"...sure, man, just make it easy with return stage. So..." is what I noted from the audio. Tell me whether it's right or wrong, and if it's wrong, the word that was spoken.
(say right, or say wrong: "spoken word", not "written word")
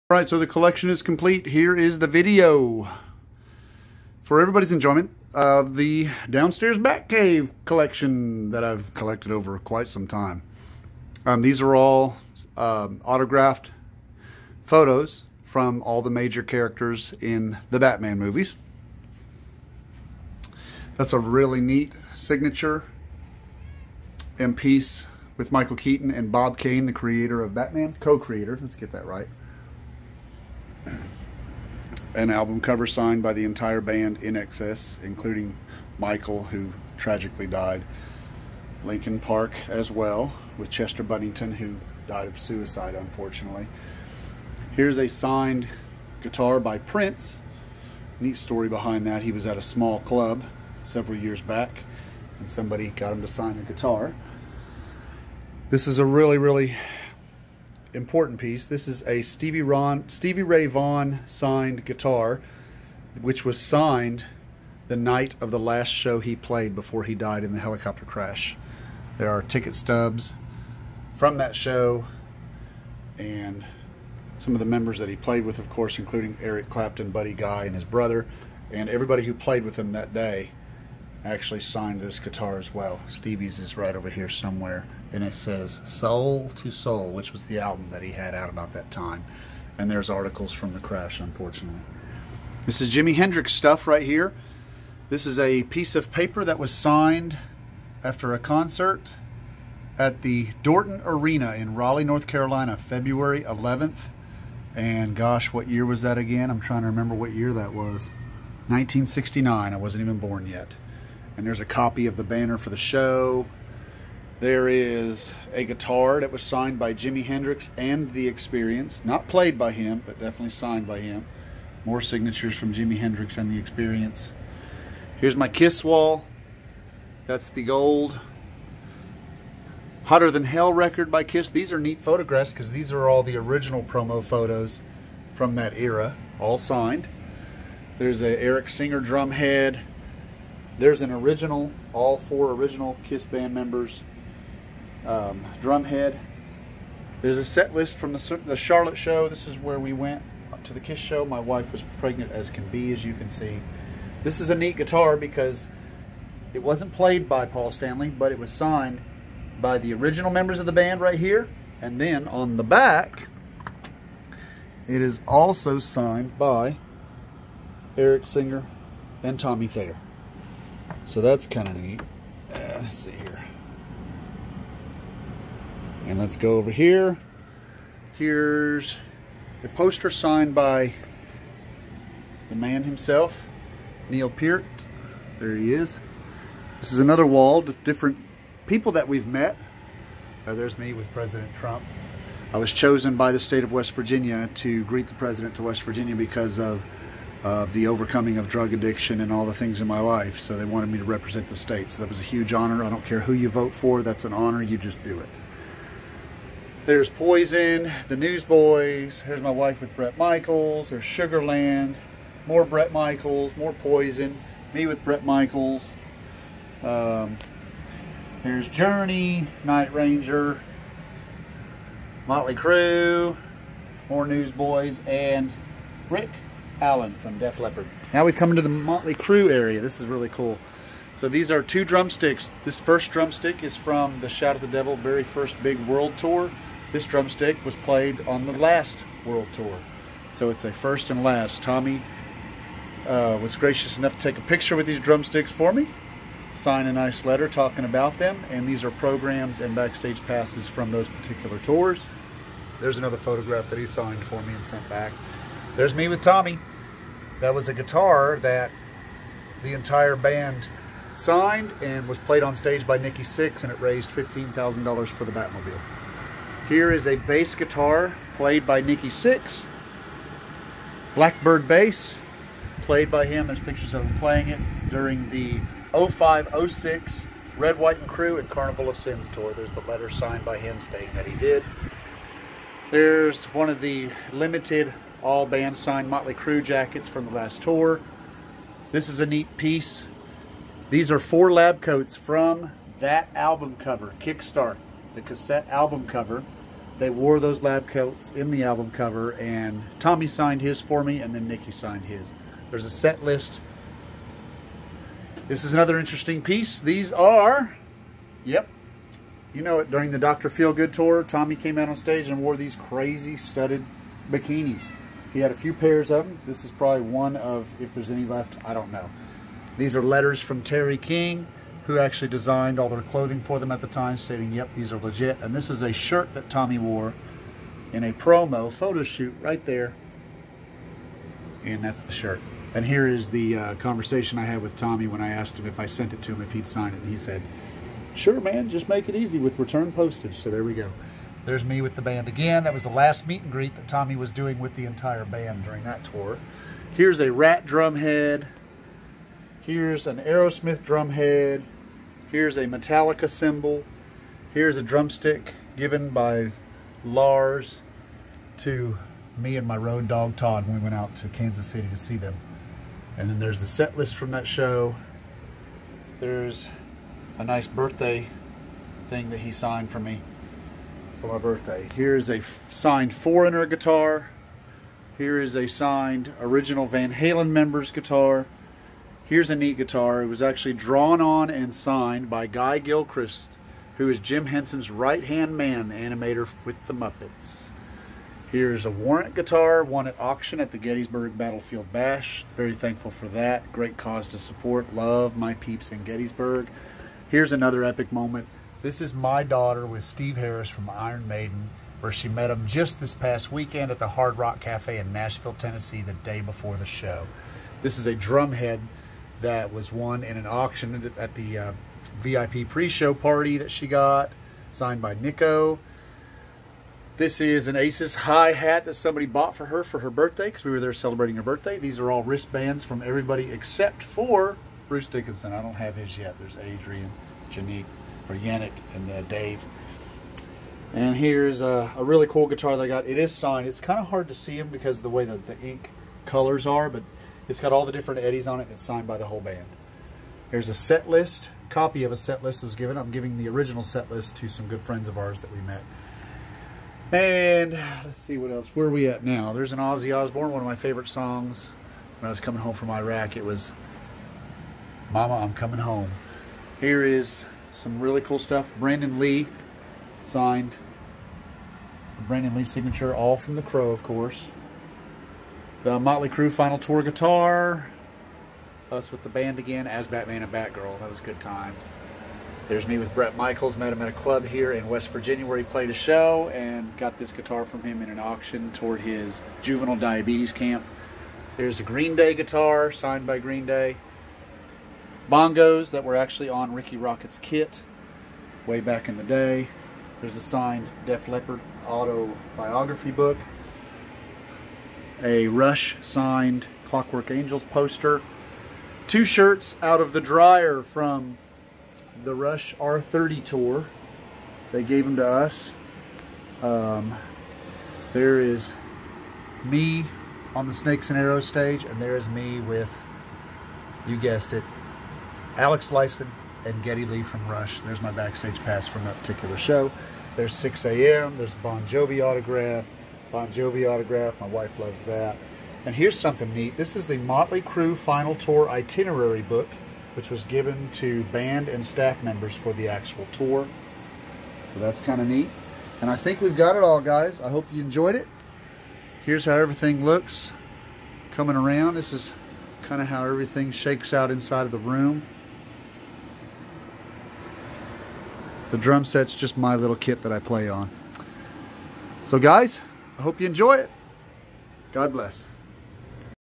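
wrong: "postage", not "stage".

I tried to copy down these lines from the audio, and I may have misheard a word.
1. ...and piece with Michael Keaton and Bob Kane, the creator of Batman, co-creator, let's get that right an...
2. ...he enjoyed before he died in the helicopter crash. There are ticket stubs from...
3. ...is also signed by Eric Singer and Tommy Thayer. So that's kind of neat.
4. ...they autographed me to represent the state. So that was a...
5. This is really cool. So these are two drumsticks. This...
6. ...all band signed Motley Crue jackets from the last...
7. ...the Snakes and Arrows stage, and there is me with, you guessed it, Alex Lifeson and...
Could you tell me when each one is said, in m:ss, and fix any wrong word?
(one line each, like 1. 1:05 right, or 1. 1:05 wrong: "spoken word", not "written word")
1. 0:24 right
2. 1:06 wrong: "played", not "enjoyed"
3. 2:45 right
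4. 3:20 wrong: "wanted", not "autographed"
5. 3:49 right
6. 4:45 right
7. 8:30 right.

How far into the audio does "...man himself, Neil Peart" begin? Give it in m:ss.
3:02.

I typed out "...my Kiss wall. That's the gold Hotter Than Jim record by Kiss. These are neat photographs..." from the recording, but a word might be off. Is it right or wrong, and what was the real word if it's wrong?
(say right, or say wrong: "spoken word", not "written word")
wrong: "Hell", not "Jim".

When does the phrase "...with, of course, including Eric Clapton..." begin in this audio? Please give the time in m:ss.
1:15.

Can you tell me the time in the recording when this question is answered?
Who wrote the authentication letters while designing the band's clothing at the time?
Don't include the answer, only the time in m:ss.
5:20.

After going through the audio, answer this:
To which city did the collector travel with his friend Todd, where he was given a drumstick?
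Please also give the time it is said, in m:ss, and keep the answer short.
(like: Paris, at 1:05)
Kansas City, at 6:01.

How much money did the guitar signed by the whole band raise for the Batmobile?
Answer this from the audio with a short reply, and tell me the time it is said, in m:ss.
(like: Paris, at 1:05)
$15,000, at 4:24.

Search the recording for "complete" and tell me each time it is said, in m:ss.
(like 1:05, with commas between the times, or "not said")
0:01.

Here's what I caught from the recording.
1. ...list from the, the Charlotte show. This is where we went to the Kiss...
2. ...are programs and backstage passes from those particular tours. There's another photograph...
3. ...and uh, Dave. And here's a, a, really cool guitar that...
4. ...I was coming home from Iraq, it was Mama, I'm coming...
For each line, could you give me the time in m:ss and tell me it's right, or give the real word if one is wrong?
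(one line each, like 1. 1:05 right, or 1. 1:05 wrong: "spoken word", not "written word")
1. 2:27 right
2. 4:08 right
3. 7:08 right
4. 7:32 right.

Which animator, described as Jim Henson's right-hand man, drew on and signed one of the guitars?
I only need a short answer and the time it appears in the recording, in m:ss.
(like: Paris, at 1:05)
Guy Gilchrist, at 6:22.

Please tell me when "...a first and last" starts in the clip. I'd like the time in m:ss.
4:00.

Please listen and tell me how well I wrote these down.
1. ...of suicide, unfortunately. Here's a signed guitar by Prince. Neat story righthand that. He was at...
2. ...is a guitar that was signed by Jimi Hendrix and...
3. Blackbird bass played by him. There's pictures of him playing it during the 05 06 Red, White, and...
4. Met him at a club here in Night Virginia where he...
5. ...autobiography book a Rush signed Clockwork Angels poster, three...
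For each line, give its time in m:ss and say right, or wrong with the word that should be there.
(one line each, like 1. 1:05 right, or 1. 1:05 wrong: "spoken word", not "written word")
1. 0:42 wrong: "behind", not "righthand"
2. 1:54 right
3. 4:31 right
4. 7:53 wrong: "West", not "Night"
5. 8:11 wrong: "two", not "three".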